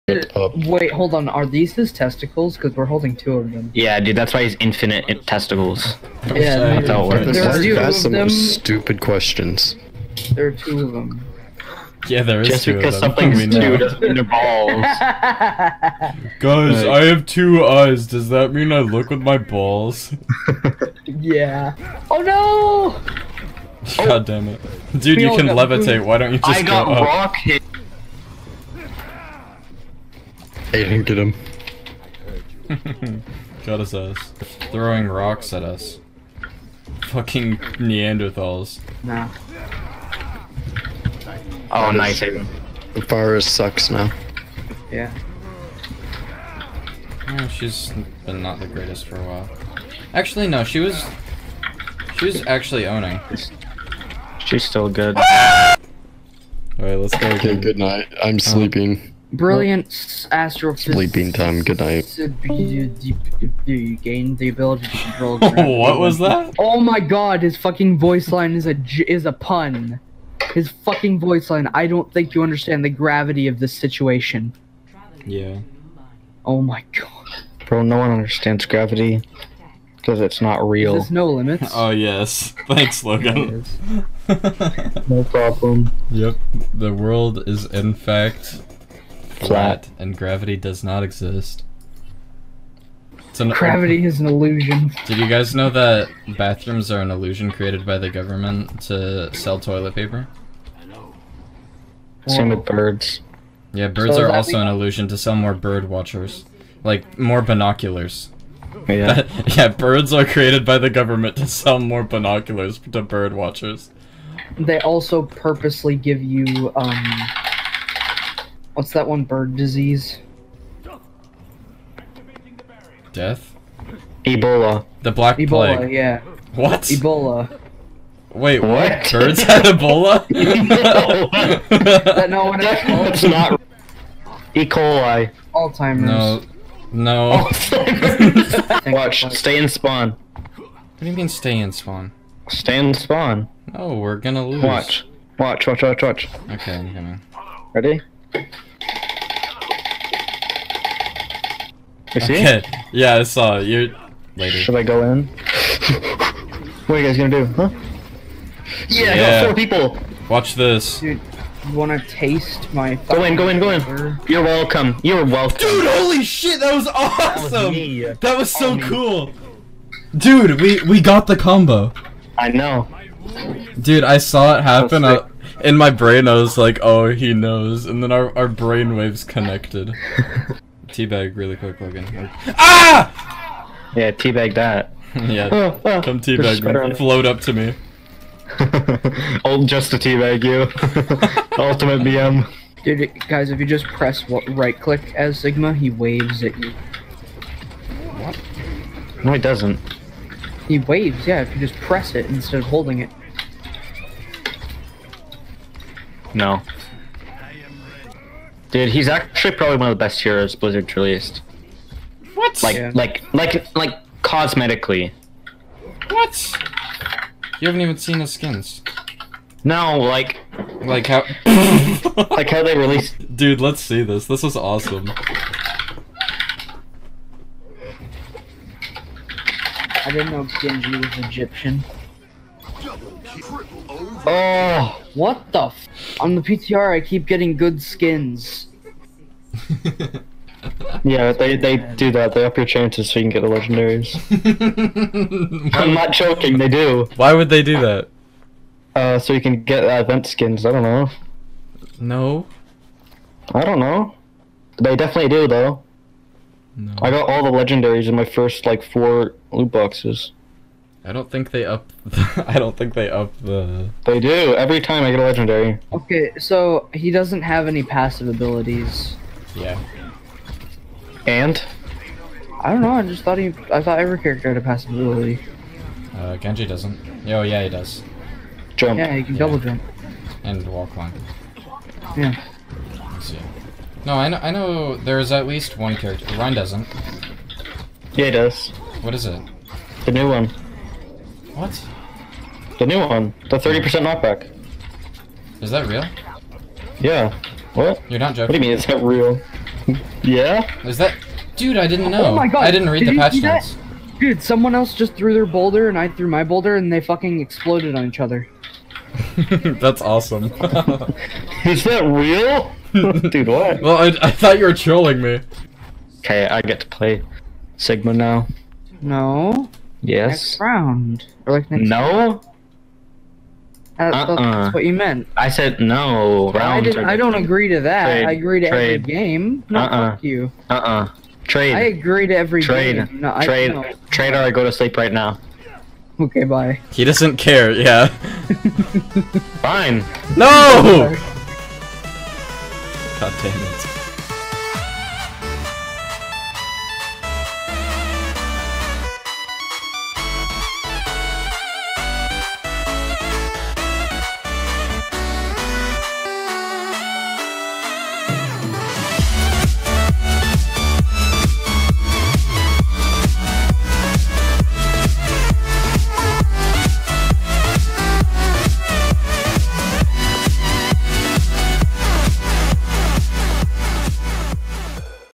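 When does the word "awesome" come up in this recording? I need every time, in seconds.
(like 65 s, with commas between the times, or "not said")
166 s, 224 s, 310 s.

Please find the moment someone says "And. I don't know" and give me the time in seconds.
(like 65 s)
271 s.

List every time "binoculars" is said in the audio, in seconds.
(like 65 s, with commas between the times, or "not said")
107 s, 112 s.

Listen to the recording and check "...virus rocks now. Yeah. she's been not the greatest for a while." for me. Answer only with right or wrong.
wrong.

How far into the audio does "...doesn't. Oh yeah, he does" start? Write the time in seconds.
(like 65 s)
276 s.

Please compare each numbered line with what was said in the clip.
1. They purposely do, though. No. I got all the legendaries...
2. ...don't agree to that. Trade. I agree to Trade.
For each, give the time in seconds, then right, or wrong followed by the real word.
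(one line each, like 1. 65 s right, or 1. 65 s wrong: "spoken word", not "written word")
1. 254 s wrong: "definitely", not "purposely"
2. 327 s right.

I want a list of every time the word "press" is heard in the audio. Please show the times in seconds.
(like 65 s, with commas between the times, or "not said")
193 s, 201 s.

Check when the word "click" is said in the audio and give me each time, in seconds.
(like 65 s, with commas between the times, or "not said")
194 s.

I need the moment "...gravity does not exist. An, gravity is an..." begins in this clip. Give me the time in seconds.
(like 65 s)
90 s.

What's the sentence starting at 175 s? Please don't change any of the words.
I, uh, in my brain, I was like, oh, he knows.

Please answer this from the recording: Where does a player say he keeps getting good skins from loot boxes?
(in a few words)
The PTR.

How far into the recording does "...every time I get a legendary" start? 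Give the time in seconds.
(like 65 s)
264 s.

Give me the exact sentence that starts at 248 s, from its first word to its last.
Uh, so you can get uh, event skins, I don't know.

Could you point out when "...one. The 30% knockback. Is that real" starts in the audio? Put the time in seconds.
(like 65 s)
292 s.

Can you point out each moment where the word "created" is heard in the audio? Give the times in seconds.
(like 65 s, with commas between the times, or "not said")
97 s, 110 s.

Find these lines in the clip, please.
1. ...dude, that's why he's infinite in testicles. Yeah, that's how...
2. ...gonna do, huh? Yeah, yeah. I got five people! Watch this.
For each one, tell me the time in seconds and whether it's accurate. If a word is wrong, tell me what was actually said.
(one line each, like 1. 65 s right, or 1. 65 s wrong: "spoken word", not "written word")
1. 3 s right
2. 157 s wrong: "four", not "five".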